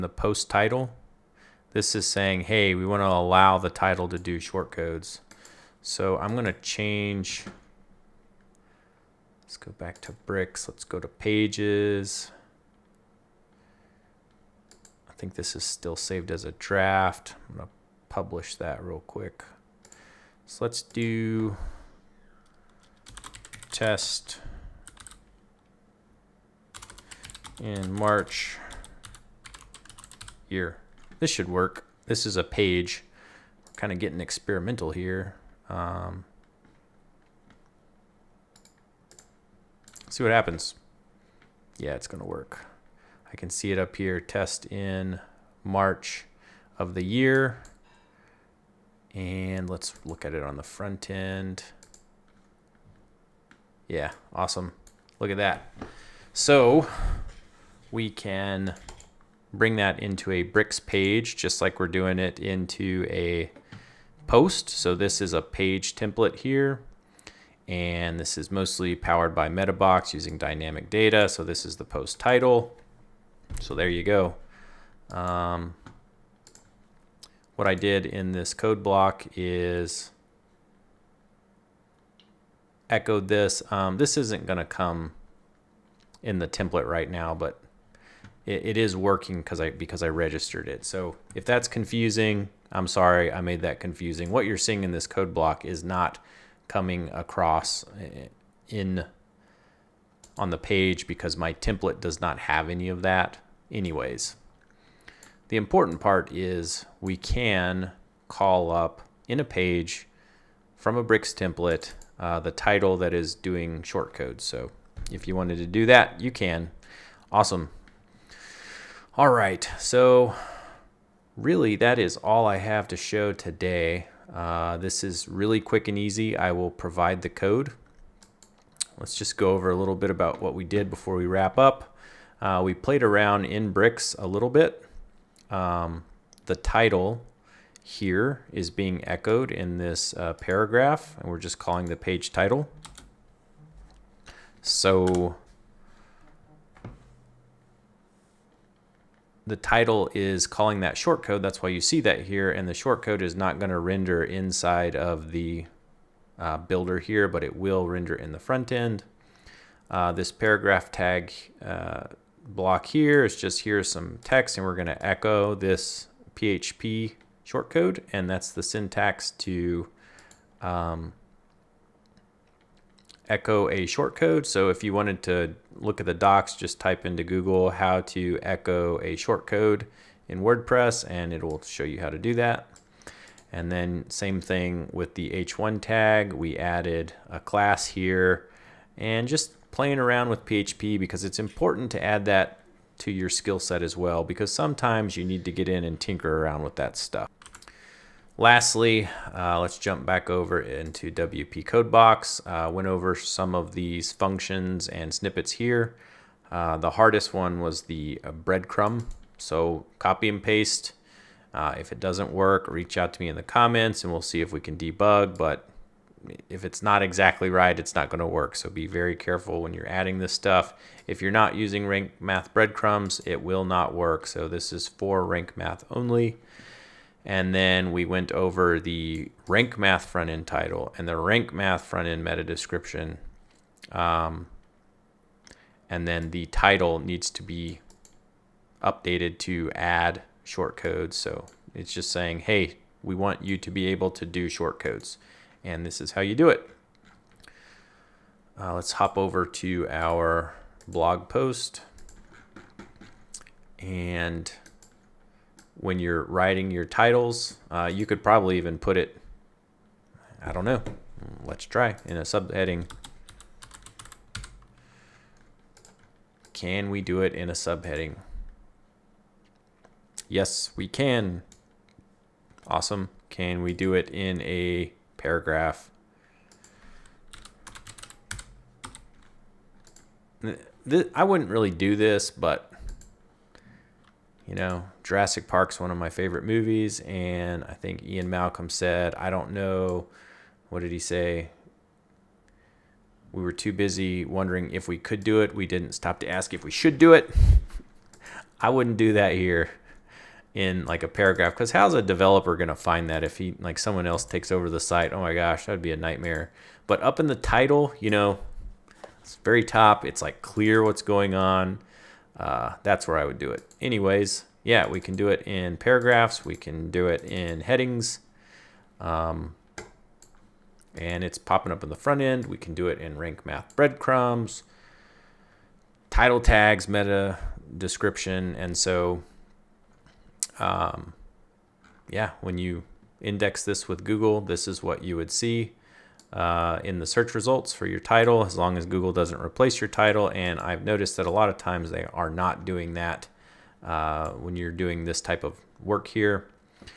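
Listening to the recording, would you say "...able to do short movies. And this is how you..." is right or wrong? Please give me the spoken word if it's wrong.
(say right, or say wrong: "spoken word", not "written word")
wrong: "codes", not "movies".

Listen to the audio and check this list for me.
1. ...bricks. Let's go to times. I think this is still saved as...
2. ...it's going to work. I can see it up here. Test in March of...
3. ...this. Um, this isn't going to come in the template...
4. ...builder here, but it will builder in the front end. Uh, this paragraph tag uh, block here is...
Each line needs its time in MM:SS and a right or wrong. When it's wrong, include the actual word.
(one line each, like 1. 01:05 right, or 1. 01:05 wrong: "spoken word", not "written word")
1. 00:10 wrong: "pages", not "times"
2. 00:41 right
3. 01:23 right
4. 02:36 wrong: "render", not "builder".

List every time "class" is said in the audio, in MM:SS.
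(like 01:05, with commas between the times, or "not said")
03:07.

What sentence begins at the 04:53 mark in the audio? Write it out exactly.
We were too busy wondering if we could do it.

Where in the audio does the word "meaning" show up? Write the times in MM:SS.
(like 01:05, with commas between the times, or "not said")
not said.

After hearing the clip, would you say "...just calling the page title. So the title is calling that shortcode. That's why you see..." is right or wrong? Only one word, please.
right.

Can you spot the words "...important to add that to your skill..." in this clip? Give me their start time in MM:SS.
03:11.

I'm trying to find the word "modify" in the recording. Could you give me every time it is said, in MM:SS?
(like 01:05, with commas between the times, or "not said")
not said.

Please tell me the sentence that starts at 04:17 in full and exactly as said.
Uh, you could probably even put it, I don't know, let's try, in a subheading.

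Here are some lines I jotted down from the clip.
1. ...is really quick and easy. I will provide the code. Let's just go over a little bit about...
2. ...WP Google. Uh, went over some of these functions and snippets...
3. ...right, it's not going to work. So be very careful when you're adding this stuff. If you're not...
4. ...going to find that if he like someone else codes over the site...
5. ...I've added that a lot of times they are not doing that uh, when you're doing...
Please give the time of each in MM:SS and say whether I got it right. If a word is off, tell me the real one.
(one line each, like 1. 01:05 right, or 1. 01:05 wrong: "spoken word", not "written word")
1. 02:05 right
2. 03:21 wrong: "Codebox", not "Google"
3. 03:37 right
4. 05:02 wrong: "takes", not "codes"
5. 05:40 wrong: "noticed", not "added".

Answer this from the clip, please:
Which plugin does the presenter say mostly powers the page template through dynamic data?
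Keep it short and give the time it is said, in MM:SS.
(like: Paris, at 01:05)
Metabox, at 01:09.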